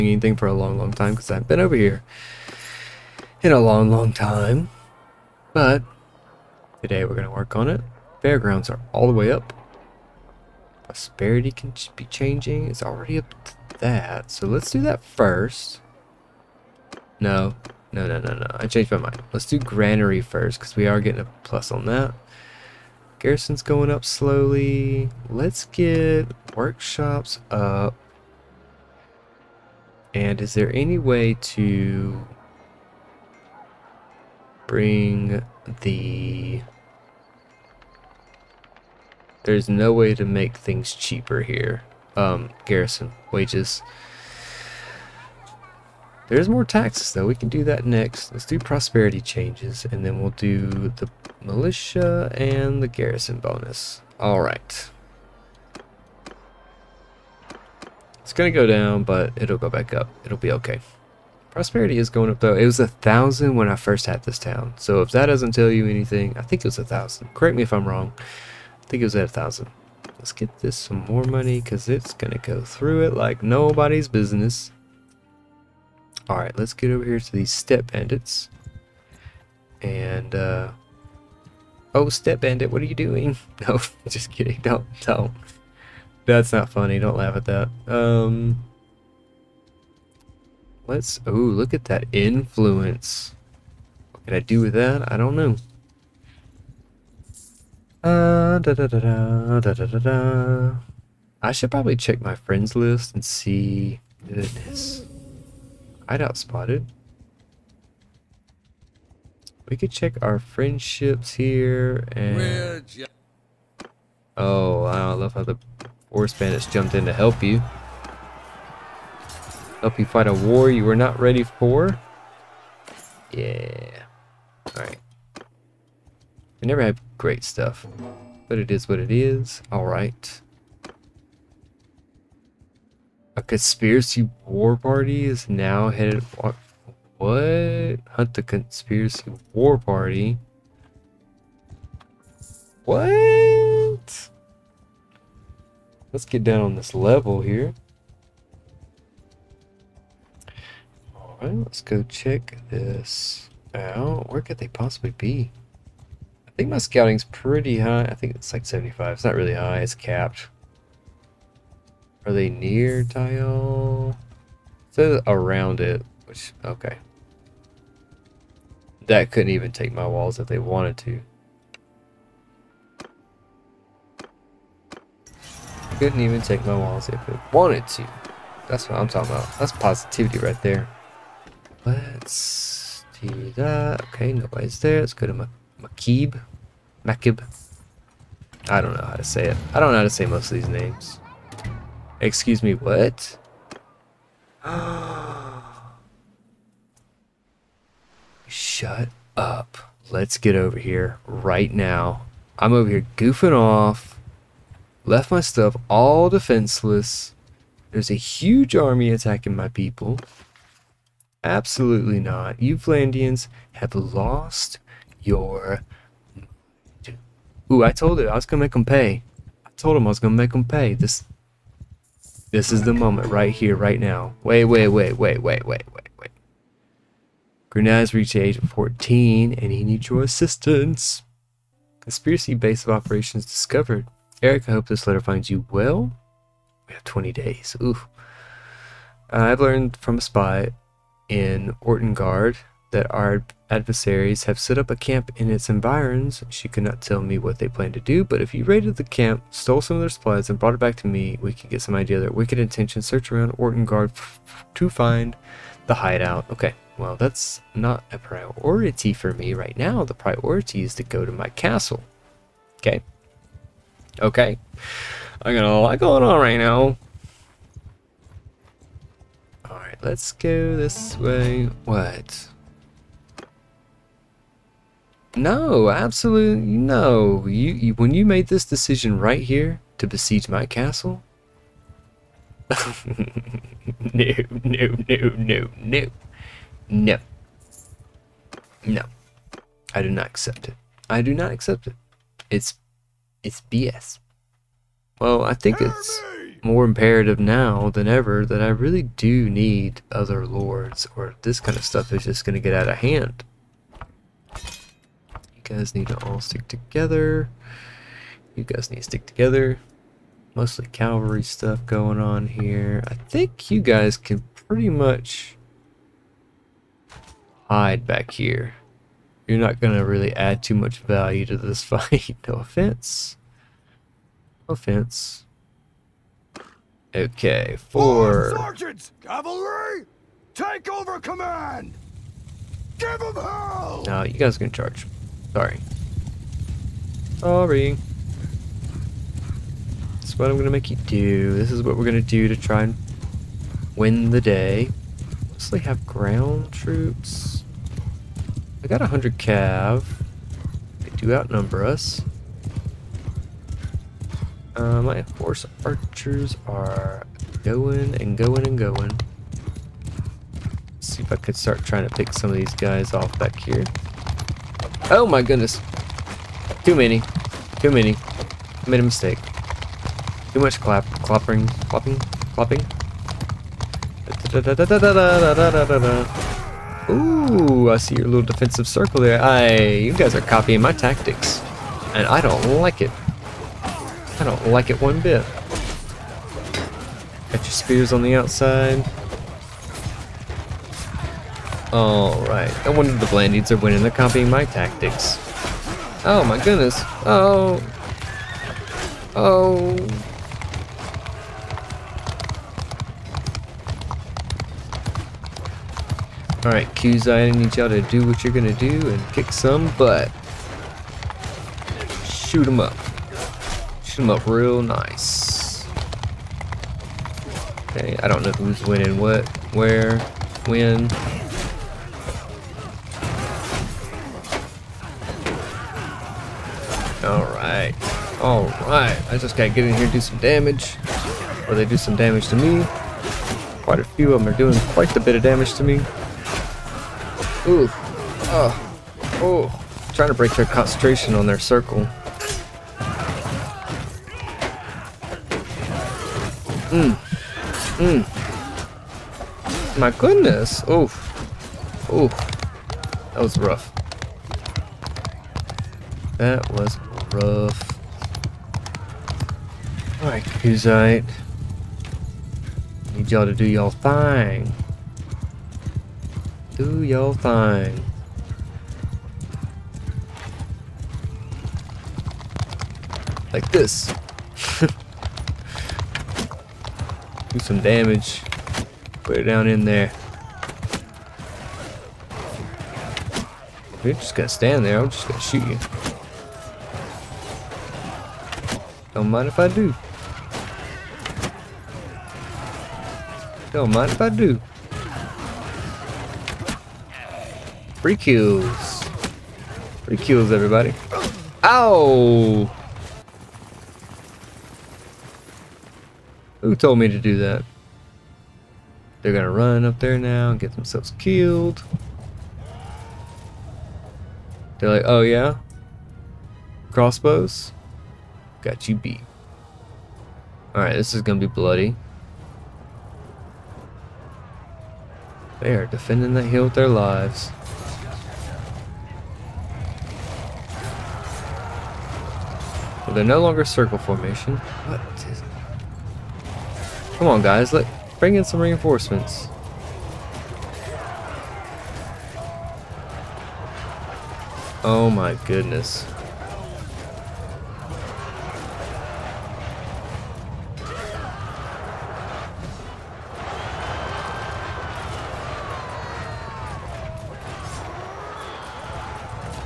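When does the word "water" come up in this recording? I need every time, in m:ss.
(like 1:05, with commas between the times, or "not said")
not said.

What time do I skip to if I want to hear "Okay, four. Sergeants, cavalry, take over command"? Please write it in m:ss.
5:27.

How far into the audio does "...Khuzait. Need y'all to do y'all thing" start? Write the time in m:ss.
7:40.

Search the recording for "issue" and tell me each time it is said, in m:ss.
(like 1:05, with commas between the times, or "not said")
not said.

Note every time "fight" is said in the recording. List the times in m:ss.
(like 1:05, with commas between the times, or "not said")
2:00, 5:21.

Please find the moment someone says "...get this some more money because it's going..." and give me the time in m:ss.
1:10.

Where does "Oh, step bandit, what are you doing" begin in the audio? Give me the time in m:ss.
1:21.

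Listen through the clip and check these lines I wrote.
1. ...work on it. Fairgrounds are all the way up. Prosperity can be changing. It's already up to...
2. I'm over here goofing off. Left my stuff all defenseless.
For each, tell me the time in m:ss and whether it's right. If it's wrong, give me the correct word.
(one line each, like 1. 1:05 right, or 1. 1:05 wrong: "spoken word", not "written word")
1. 0:07 right
2. 3:22 right.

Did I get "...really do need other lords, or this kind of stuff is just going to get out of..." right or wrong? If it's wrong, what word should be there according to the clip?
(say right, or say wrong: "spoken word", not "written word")
right.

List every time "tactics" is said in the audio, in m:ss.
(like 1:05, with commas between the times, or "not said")
6:20, 6:34.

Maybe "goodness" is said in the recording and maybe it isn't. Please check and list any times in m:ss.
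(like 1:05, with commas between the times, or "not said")
1:44, 6:05, 6:36, 7:30, 9:05.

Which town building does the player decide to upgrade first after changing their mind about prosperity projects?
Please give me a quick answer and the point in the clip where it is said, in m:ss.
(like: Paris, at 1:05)
Granary, at 0:19.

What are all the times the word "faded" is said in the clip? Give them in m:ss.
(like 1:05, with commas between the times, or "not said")
not said.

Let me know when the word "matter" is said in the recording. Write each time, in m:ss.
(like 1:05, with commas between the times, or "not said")
not said.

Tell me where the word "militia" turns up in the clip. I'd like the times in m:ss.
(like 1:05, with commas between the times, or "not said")
0:51.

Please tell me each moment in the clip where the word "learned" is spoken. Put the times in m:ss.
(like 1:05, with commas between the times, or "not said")
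3:59.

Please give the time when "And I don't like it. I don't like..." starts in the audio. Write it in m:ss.
6:22.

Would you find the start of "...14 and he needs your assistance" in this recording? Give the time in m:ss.
3:48.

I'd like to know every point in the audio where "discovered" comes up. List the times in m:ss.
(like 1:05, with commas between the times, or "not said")
3:53.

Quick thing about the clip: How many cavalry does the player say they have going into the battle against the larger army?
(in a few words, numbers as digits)
100.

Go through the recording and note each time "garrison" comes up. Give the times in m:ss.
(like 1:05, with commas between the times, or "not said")
0:23, 0:42, 0:52.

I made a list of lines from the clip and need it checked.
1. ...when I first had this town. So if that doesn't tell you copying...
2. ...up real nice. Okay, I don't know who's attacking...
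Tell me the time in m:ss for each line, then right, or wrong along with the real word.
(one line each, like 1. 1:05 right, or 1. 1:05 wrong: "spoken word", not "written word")
1. 1:03 wrong: "anything", not "copying"
2. 6:54 wrong: "winning", not "attacking".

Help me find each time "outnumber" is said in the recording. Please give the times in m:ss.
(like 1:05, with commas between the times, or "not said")
5:51.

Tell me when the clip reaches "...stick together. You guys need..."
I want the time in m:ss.
5:06.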